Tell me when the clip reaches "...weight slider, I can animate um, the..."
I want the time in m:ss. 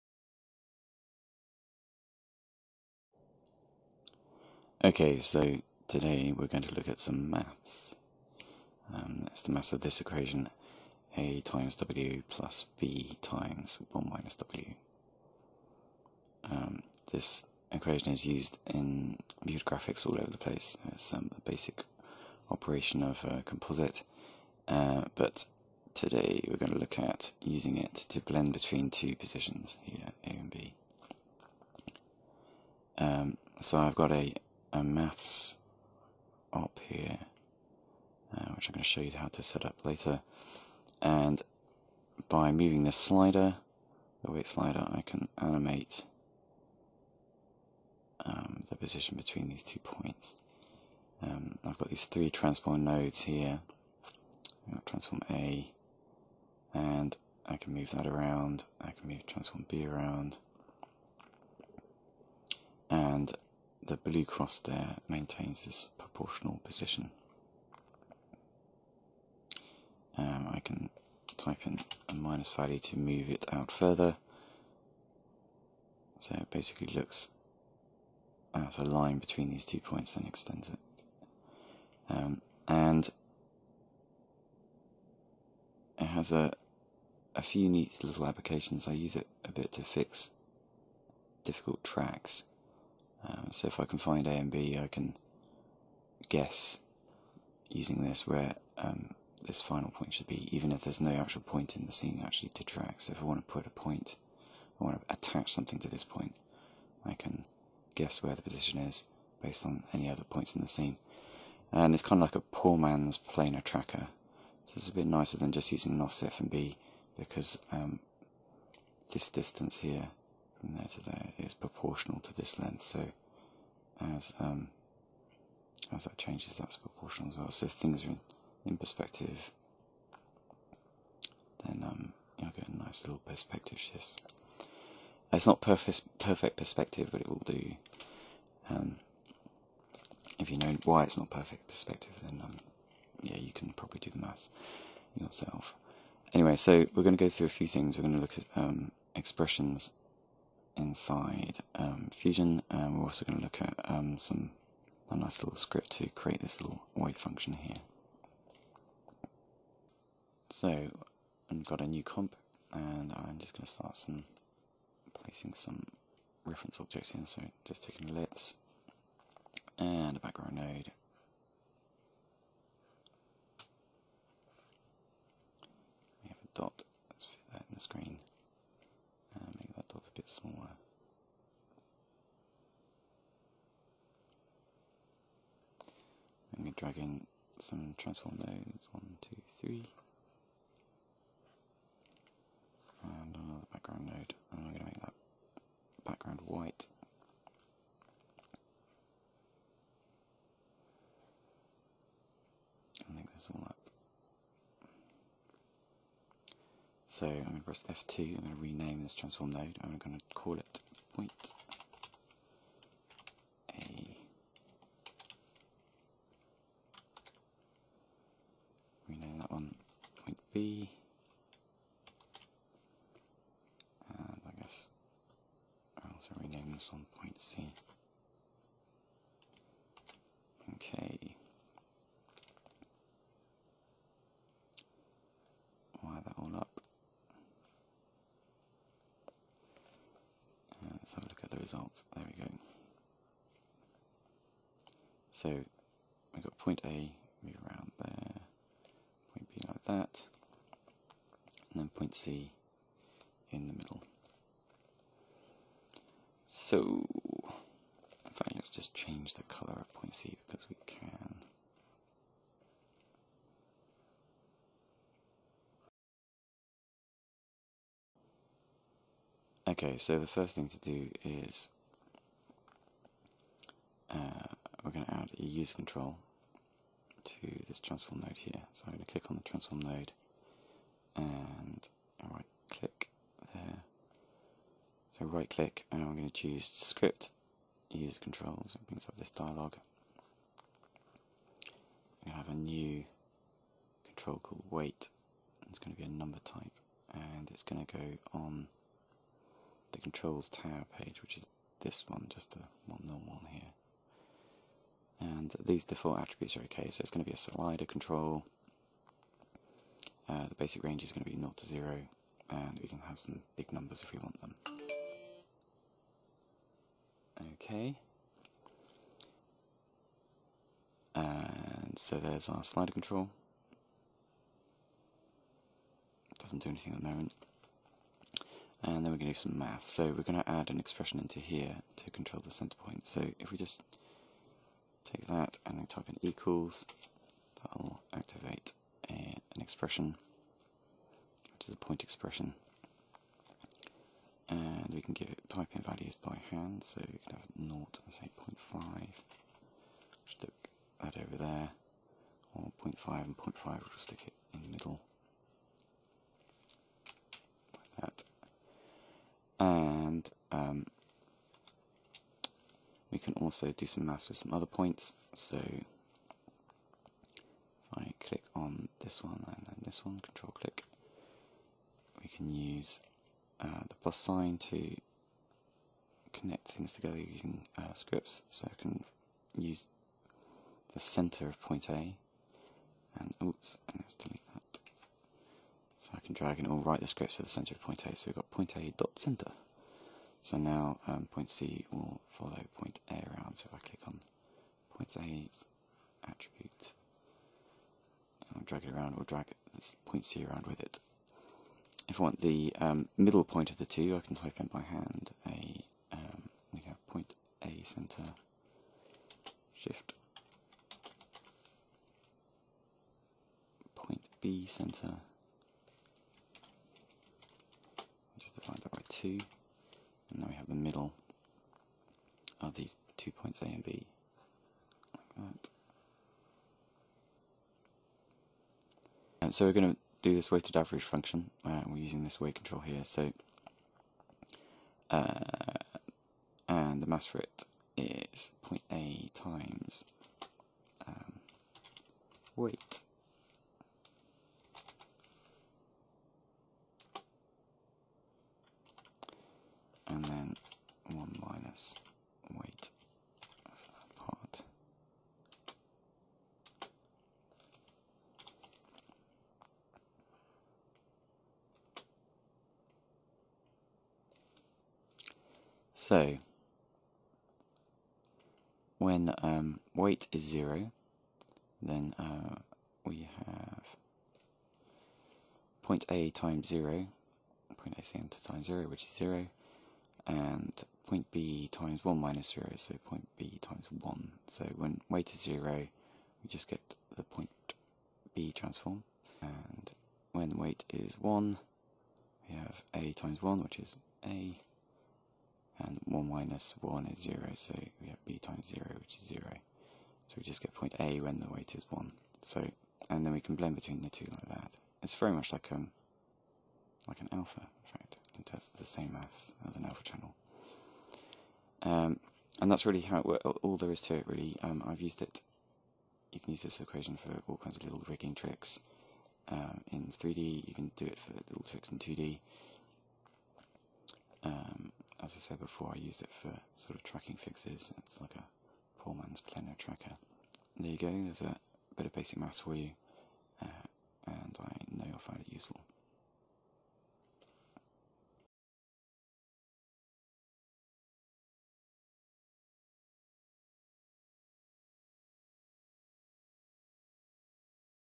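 0:44.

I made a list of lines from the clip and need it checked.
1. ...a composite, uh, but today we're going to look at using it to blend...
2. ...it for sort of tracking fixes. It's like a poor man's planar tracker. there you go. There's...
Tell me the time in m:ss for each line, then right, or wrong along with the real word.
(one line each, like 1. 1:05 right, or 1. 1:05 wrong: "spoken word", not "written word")
1. 0:23 right
2. 8:46 right.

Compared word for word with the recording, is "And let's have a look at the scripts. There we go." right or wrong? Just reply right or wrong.
wrong.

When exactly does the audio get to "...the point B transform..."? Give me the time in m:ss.
8:07.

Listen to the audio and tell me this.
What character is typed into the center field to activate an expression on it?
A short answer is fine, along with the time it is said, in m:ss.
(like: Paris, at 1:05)
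equals, at 5:36.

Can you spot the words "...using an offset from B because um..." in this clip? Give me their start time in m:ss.
1:55.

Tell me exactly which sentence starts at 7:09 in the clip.
And um, so we're going to do this weighted average function.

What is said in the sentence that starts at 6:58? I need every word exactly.
Just divide that by two, and now we have the middle of these two points A and B, like that.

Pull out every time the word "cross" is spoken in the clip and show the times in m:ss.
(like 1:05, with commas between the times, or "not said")
1:04.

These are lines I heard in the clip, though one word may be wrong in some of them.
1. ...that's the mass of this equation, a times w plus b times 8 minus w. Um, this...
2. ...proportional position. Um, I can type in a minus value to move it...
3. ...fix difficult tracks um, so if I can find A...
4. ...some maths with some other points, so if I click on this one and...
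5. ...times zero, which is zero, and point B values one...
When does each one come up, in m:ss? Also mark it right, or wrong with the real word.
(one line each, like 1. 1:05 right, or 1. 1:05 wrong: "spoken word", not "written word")
1. 0:09 wrong: "1", not "8"
2. 1:05 right
3. 1:29 right
4. 6:03 right
5. 7:58 wrong: "times", not "values".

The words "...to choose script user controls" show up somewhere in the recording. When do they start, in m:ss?
4:46.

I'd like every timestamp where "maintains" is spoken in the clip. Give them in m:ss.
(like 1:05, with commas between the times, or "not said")
1:05.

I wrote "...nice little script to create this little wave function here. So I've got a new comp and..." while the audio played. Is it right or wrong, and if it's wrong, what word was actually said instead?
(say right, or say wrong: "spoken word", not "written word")
right.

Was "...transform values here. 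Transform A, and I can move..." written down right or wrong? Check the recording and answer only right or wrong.
wrong.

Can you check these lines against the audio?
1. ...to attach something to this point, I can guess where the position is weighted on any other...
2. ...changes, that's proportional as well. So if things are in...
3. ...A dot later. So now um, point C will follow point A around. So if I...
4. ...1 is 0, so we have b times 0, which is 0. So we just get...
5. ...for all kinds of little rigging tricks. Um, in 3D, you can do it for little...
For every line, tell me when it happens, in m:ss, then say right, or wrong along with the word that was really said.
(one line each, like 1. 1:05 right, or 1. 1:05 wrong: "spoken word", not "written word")
1. 1:45 wrong: "based", not "weighted"
2. 2:06 right
3. 6:28 wrong: "center", not "later"
4. 8:16 right
5. 8:37 right.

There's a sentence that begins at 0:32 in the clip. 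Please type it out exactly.
Um, so I've got a a maths op here, uh, which I'm going to show you how to set up later.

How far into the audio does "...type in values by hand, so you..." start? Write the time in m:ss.
5:45.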